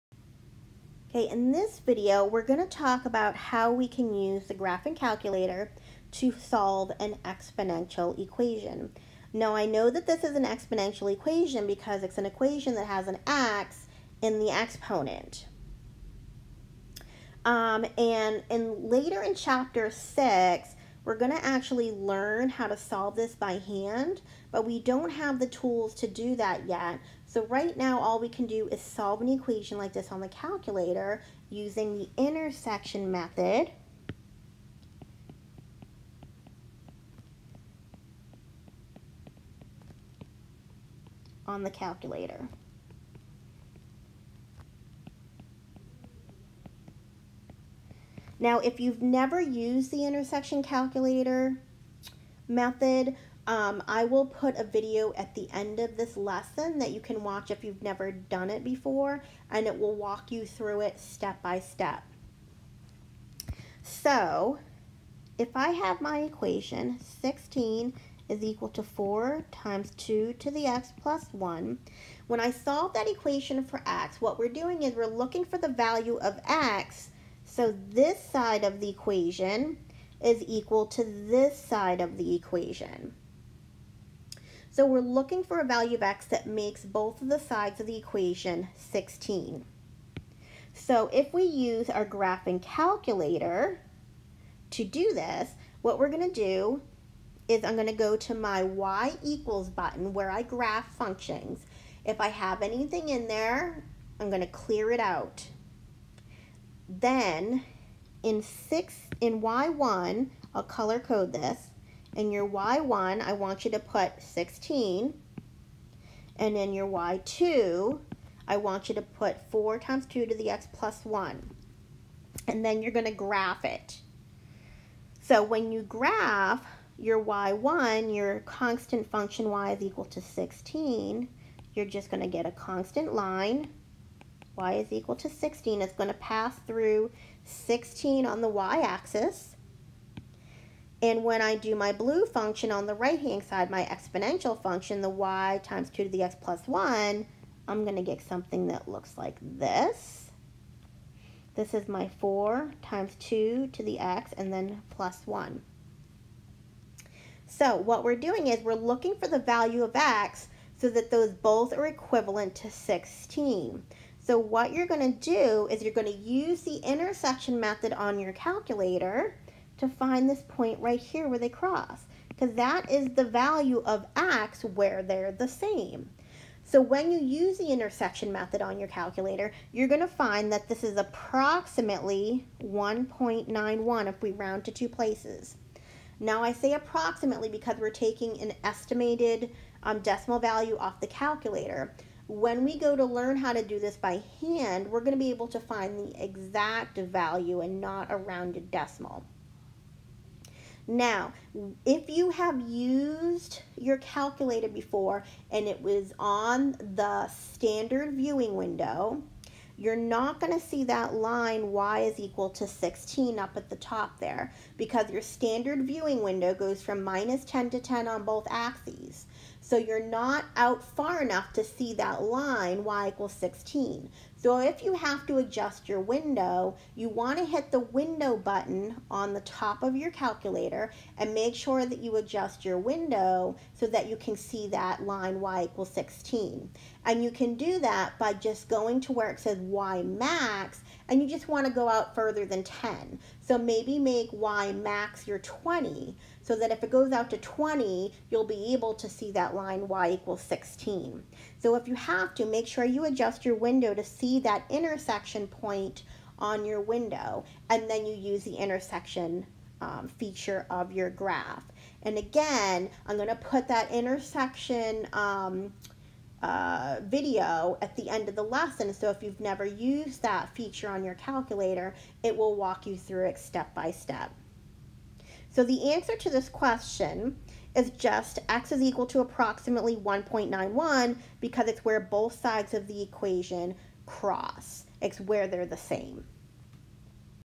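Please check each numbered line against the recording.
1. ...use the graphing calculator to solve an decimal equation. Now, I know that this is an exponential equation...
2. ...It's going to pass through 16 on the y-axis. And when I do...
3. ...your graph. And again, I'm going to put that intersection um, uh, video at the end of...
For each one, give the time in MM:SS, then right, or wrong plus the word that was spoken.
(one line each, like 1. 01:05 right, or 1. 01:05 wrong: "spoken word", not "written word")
1. 00:04 wrong: "exponential", not "decimal"
2. 02:15 right
3. 04:20 right.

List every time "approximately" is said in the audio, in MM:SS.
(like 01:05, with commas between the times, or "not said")
03:00, 03:06, 04:39.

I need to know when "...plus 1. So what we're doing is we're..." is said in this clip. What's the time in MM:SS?
02:34.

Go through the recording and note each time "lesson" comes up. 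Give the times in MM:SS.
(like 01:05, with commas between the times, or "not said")
00:56, 04:28.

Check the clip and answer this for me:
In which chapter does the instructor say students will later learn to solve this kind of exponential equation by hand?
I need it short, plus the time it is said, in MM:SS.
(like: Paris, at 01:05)
Chapter 6, at 00:19.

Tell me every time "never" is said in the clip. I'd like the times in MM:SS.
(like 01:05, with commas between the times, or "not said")
00:49, 00:57, 04:29.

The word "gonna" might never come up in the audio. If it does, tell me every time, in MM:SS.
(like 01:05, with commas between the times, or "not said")
00:02, 00:21.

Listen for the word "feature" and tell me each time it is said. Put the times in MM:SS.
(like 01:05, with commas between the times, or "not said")
04:20, 04:30.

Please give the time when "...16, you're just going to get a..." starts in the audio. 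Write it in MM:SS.
02:10.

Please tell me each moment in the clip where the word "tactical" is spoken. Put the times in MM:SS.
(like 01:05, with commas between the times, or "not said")
not said.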